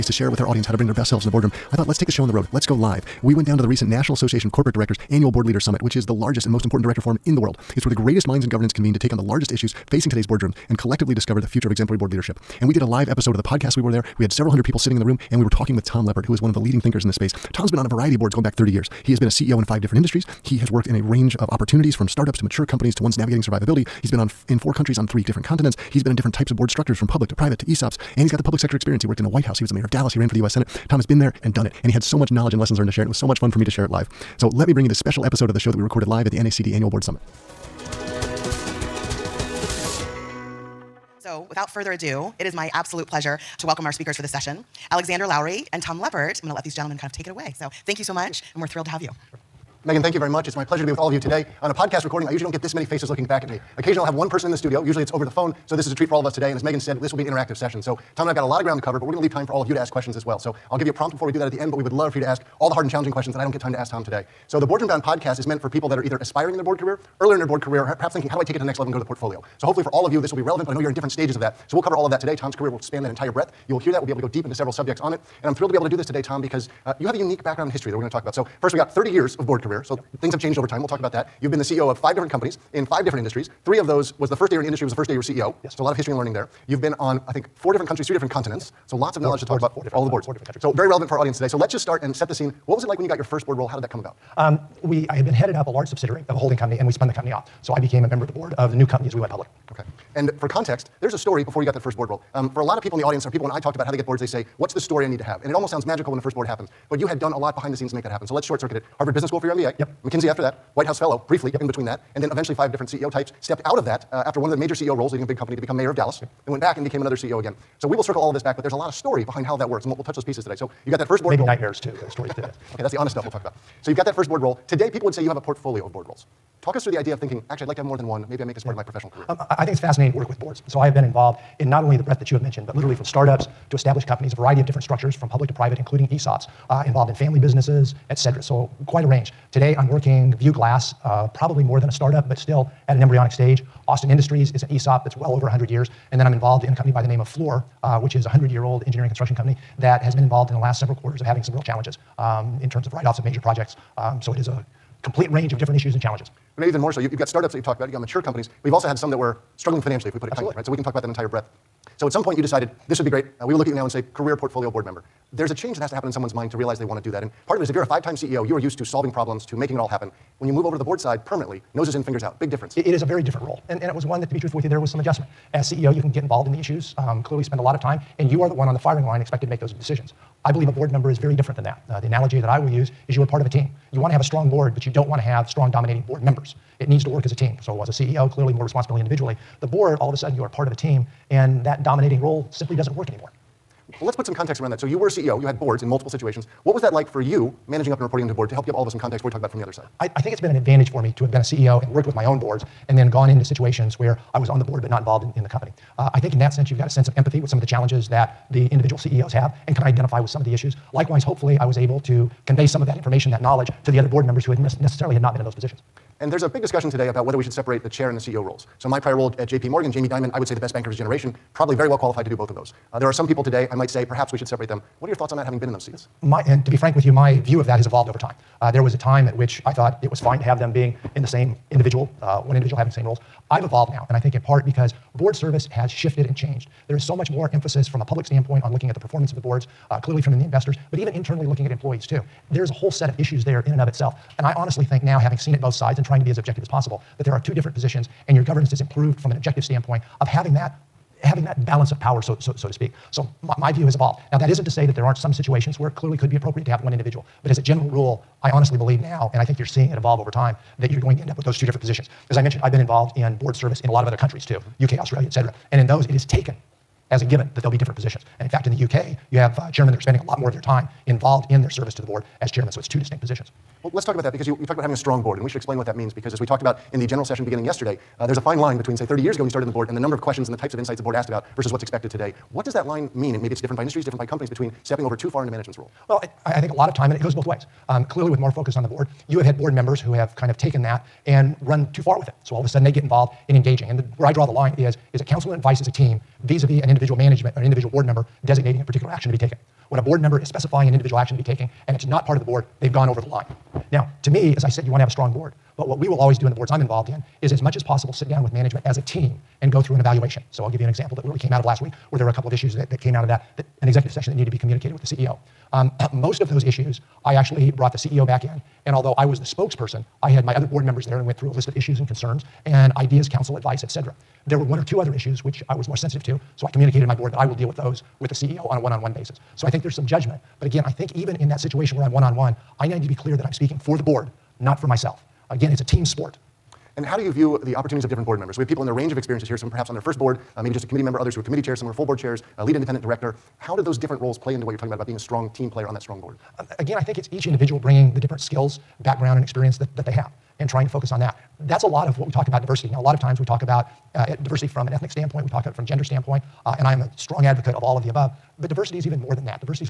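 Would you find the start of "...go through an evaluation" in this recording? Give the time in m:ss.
5:09.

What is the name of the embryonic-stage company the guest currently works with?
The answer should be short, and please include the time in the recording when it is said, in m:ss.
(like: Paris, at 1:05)
View Glass, at 2:20.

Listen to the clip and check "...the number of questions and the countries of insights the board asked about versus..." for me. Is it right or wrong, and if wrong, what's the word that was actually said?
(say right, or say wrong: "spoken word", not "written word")
wrong: "types", not "countries".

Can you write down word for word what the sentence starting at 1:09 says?
So hopefully for all of you, this will be relevant, but I know you're in different stages of that.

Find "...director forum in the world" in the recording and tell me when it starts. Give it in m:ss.
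0:06.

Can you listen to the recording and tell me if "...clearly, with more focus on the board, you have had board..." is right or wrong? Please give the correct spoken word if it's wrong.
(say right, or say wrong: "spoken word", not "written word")
right.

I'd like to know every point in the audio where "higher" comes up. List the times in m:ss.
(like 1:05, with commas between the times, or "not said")
not said.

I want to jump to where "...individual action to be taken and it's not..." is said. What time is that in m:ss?
5:00.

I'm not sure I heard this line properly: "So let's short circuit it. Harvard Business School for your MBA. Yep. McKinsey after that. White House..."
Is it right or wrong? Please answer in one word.
right.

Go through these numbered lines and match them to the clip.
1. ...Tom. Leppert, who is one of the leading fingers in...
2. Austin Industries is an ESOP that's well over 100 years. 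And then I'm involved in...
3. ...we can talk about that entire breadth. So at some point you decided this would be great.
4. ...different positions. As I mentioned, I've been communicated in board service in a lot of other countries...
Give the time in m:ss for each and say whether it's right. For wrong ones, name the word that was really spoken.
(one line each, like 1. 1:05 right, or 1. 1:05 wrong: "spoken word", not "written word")
1. 0:15 wrong: "thinkers", not "fingers"
2. 2:23 right
3. 2:40 right
4. 4:21 wrong: "involved", not "communicated".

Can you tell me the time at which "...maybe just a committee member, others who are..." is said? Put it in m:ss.
5:40.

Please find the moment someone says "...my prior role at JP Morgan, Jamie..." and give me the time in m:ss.
3:38.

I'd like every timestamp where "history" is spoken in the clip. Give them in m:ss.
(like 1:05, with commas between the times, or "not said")
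1:17, 1:25.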